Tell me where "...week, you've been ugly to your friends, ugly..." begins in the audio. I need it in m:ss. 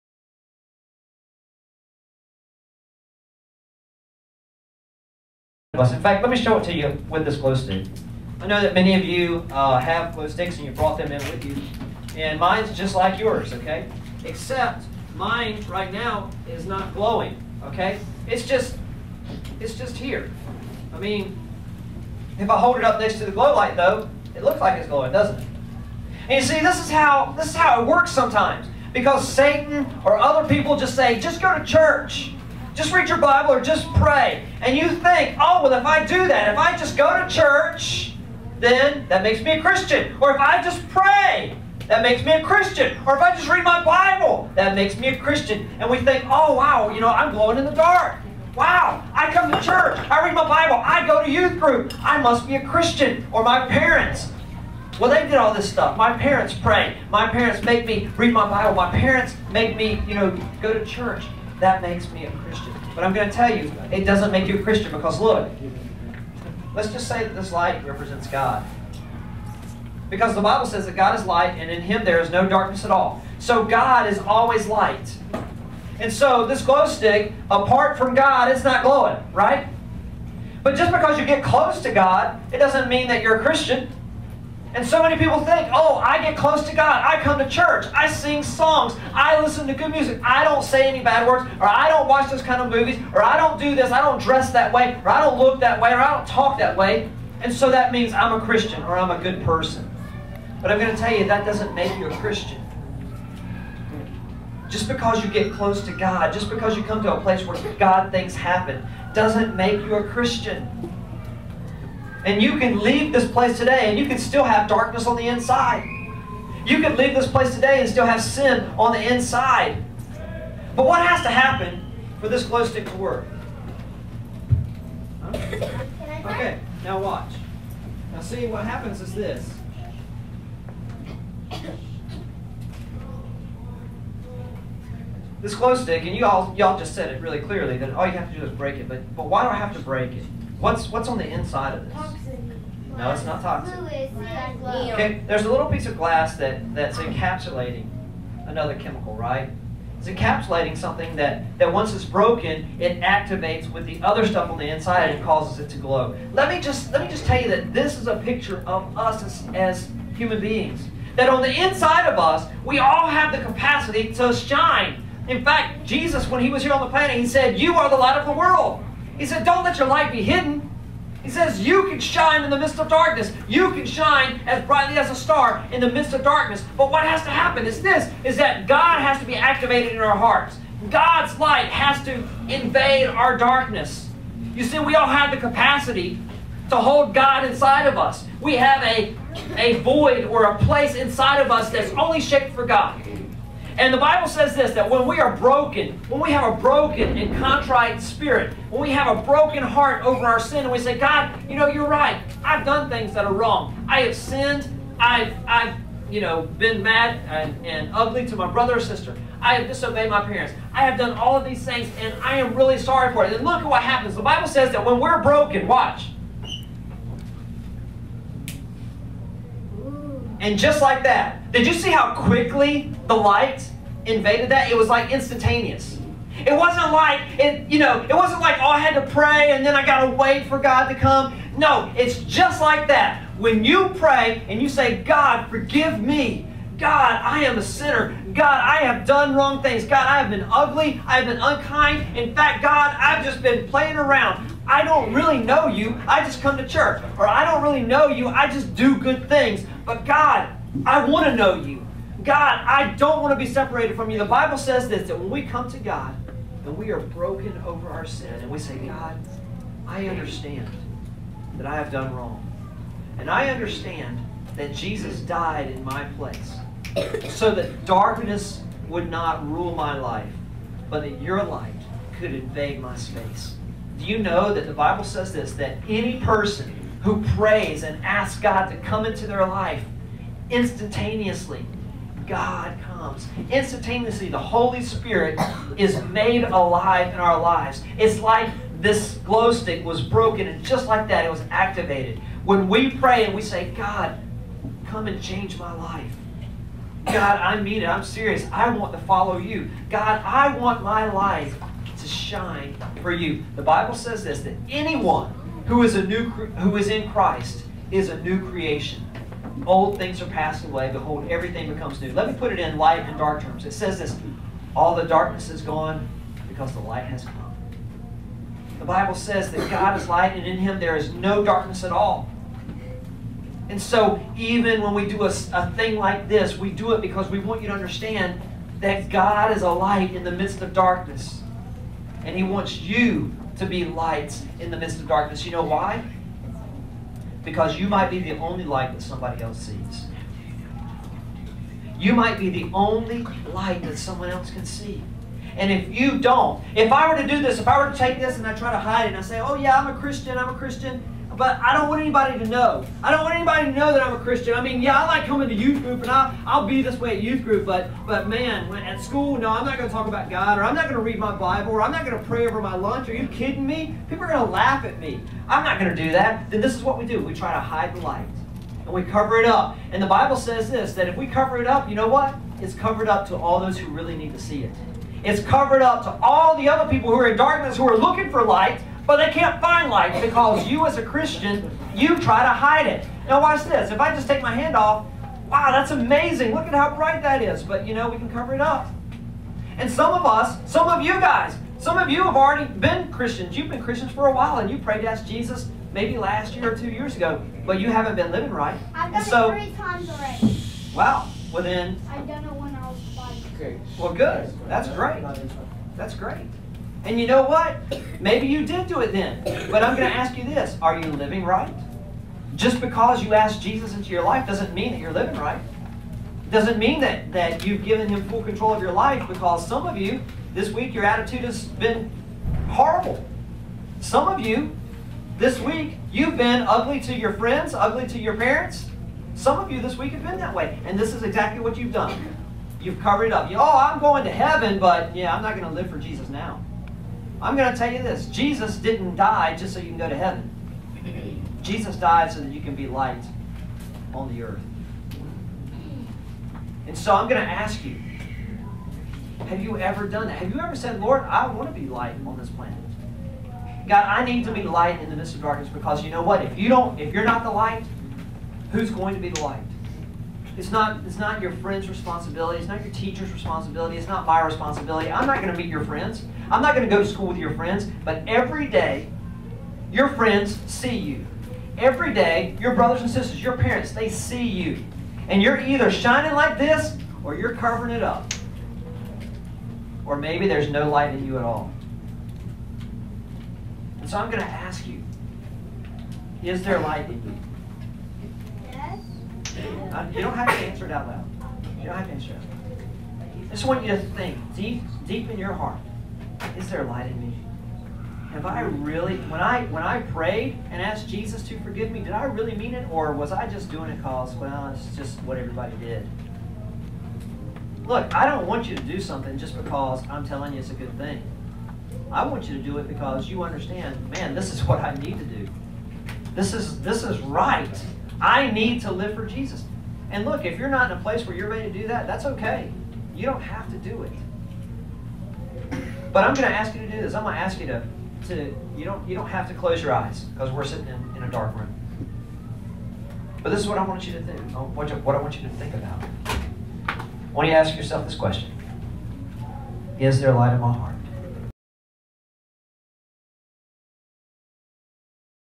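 7:05.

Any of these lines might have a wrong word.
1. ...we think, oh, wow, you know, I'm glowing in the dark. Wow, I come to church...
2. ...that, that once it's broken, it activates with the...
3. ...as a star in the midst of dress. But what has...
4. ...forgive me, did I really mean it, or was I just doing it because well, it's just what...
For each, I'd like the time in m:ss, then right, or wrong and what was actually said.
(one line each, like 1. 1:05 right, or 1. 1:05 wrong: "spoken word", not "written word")
1. 0:45 right
2. 2:31 right
3. 2:54 wrong: "darkness", not "dress"
4. 8:21 right.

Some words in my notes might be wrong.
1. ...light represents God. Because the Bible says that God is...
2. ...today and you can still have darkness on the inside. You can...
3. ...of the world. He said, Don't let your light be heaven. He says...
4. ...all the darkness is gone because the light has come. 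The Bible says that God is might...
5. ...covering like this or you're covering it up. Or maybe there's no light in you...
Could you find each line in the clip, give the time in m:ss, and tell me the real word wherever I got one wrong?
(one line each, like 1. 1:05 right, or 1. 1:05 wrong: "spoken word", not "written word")
1. 1:07 right
2. 1:53 right
3. 2:48 wrong: "hidden", not "heaven"
4. 5:14 wrong: "light", not "might"
5. 7:55 wrong: "shining", not "covering".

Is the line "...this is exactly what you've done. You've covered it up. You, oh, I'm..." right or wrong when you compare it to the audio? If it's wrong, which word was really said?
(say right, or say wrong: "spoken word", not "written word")
right.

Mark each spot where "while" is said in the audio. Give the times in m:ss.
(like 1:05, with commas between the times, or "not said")
6:34.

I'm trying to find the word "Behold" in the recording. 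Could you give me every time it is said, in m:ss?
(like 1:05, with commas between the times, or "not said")
5:10.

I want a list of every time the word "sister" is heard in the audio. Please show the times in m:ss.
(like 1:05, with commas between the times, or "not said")
3:28, 7:53.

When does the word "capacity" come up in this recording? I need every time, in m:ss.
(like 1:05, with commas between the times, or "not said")
2:43, 3:05.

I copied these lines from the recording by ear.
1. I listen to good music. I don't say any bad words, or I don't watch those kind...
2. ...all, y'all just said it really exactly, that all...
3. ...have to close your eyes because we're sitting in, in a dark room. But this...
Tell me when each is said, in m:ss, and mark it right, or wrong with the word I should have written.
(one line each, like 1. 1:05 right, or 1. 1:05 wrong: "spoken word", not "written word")
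1. 1:29 right
2. 2:16 wrong: "clearly", not "exactly"
3. 8:49 right.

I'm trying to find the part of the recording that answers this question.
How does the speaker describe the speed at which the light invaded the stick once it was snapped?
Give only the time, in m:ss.
3:45.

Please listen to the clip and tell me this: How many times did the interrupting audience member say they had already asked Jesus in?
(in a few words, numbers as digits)
3.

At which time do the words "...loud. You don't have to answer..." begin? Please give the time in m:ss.
8:11.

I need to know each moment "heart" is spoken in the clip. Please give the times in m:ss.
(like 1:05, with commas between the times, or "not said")
3:00, 3:19, 8:15, 9:00.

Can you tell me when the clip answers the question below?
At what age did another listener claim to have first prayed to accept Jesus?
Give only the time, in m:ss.
6:43.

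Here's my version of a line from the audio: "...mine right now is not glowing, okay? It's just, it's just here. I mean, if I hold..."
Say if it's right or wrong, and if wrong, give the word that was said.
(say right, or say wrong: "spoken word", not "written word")
right.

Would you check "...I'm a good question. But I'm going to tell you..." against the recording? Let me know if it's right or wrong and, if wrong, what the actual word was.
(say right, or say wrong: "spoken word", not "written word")
wrong: "person", not "question".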